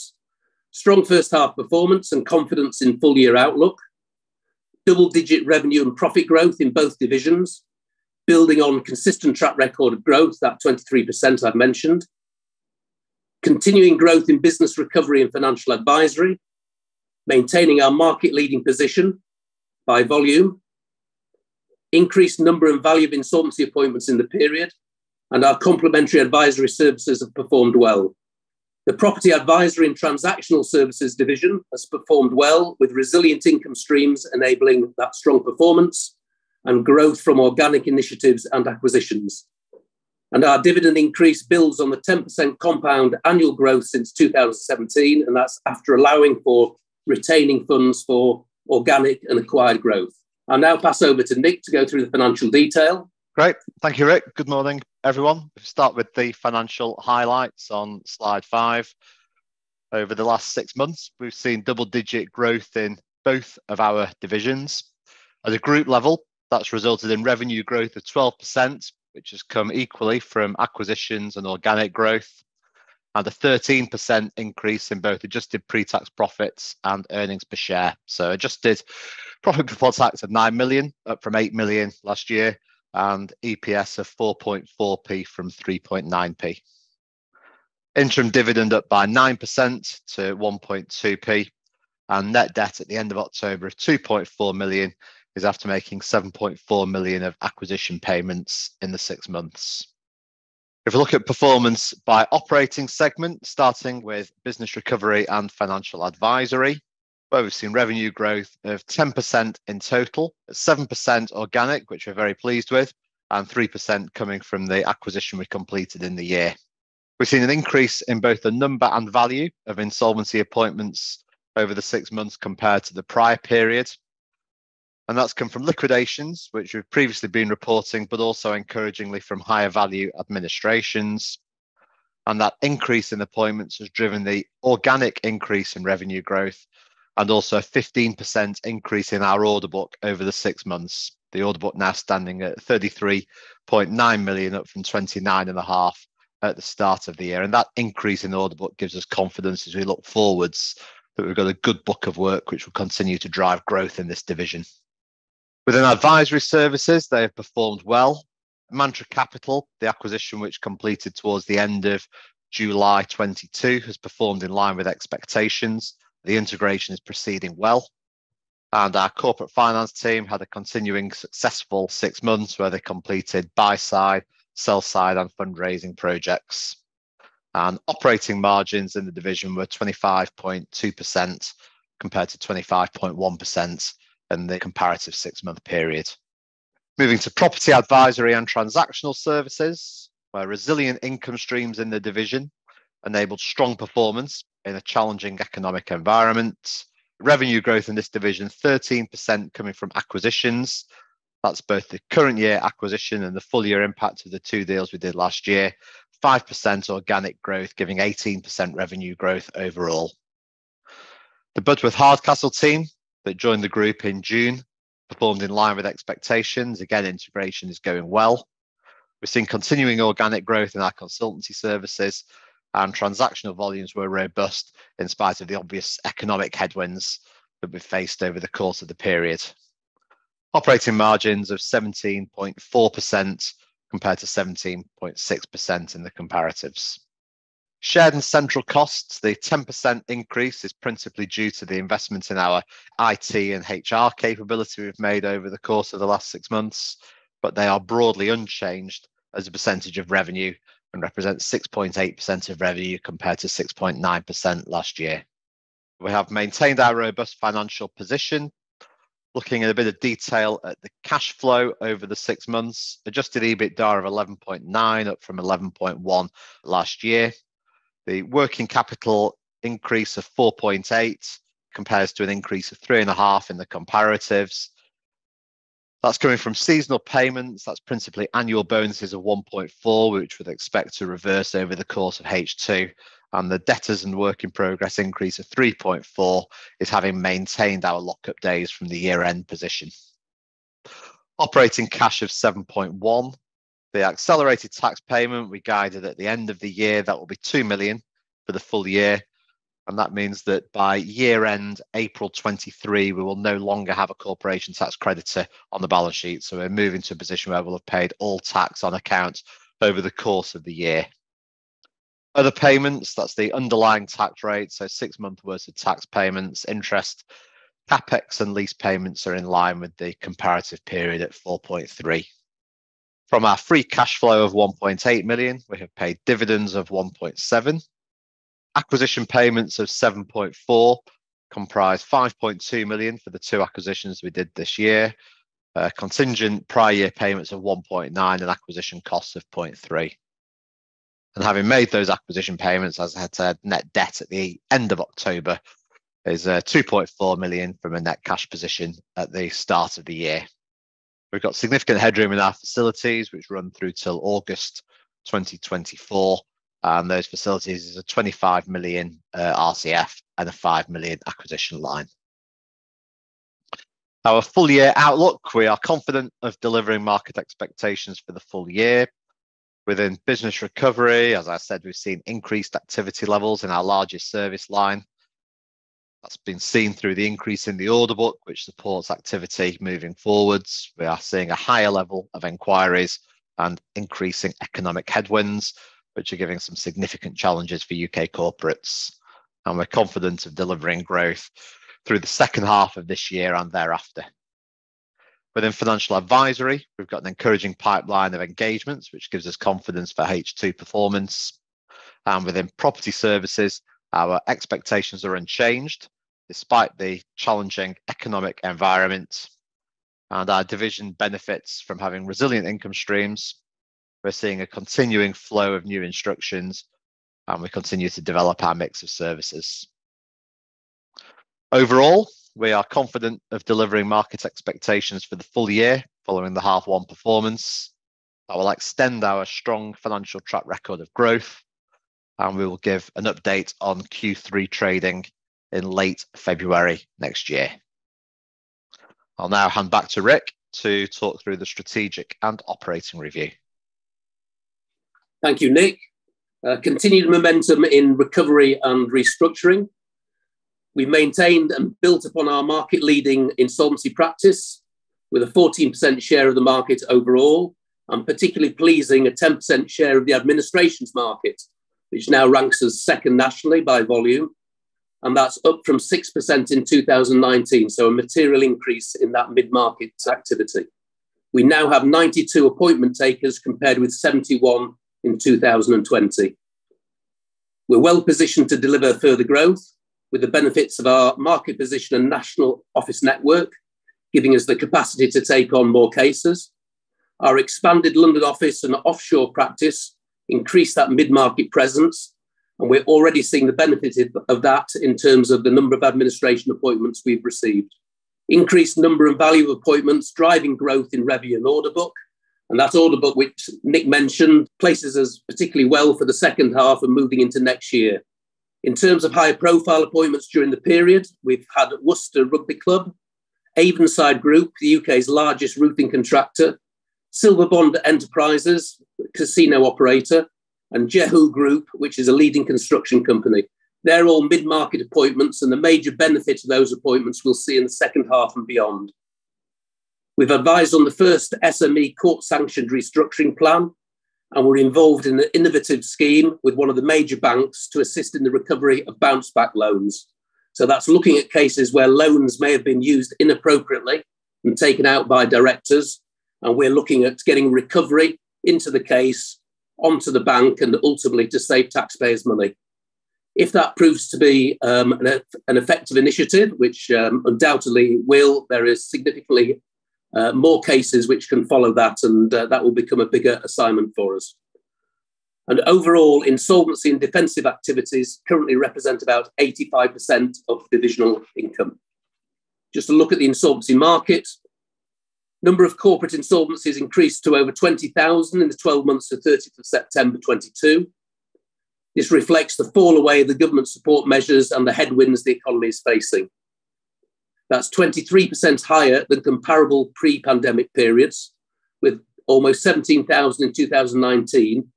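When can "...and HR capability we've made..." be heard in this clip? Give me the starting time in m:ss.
4:03.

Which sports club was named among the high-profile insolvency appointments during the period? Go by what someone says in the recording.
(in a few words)
Worcester Rugby Club.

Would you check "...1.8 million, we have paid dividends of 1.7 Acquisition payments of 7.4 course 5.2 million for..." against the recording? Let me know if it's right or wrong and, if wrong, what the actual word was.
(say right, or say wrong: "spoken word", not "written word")
wrong: "comprise", not "course".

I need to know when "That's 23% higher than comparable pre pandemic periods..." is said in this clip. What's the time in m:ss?
9:47.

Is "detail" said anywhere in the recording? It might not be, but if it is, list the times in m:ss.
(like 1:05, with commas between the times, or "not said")
0:52, 4:19.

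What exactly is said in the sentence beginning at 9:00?
So that's looking at cases where loans may have been used inappropriately and taken out by directors.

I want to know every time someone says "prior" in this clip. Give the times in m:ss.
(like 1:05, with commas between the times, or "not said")
2:03, 5:36.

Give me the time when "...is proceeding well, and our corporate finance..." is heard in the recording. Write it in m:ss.
2:46.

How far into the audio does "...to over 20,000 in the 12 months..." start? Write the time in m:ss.
9:37.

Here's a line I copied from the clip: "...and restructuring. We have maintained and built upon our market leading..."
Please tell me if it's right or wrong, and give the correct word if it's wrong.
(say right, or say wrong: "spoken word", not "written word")
right.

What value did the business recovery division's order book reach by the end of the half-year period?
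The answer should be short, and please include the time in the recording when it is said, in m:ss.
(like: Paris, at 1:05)
33.9 million, at 2:22.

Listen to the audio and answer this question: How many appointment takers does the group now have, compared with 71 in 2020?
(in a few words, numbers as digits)
92.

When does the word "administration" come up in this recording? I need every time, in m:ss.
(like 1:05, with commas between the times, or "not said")
2:10, 7:40, 8:16.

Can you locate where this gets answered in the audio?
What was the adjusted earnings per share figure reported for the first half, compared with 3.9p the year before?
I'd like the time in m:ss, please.
1:24.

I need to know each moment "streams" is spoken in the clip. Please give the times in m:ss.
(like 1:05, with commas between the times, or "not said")
0:33, 3:11, 6:52.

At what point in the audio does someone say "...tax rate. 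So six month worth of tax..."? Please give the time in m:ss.
5:14.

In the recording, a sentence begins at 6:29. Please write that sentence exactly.
And we're confident of delivering growth through the second half of this year and thereafter.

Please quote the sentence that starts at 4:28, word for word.
The working capital increase of 4.8 compares to an increase of 3.5 in the comparatives.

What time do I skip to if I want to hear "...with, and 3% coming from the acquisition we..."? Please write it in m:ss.
1:52.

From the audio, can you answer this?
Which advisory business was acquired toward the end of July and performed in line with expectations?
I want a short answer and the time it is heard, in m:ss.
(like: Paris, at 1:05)
Mantra Capital, at 2:38.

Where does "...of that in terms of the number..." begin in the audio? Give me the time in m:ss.
8:14.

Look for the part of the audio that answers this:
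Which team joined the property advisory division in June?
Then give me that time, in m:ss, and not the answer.
3:31.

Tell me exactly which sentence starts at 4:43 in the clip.
And the debtors and work in progress increase of 3.4 is having maintained our lockup days from the year end position.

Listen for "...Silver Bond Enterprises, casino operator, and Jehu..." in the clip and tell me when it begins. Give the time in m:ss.
8:37.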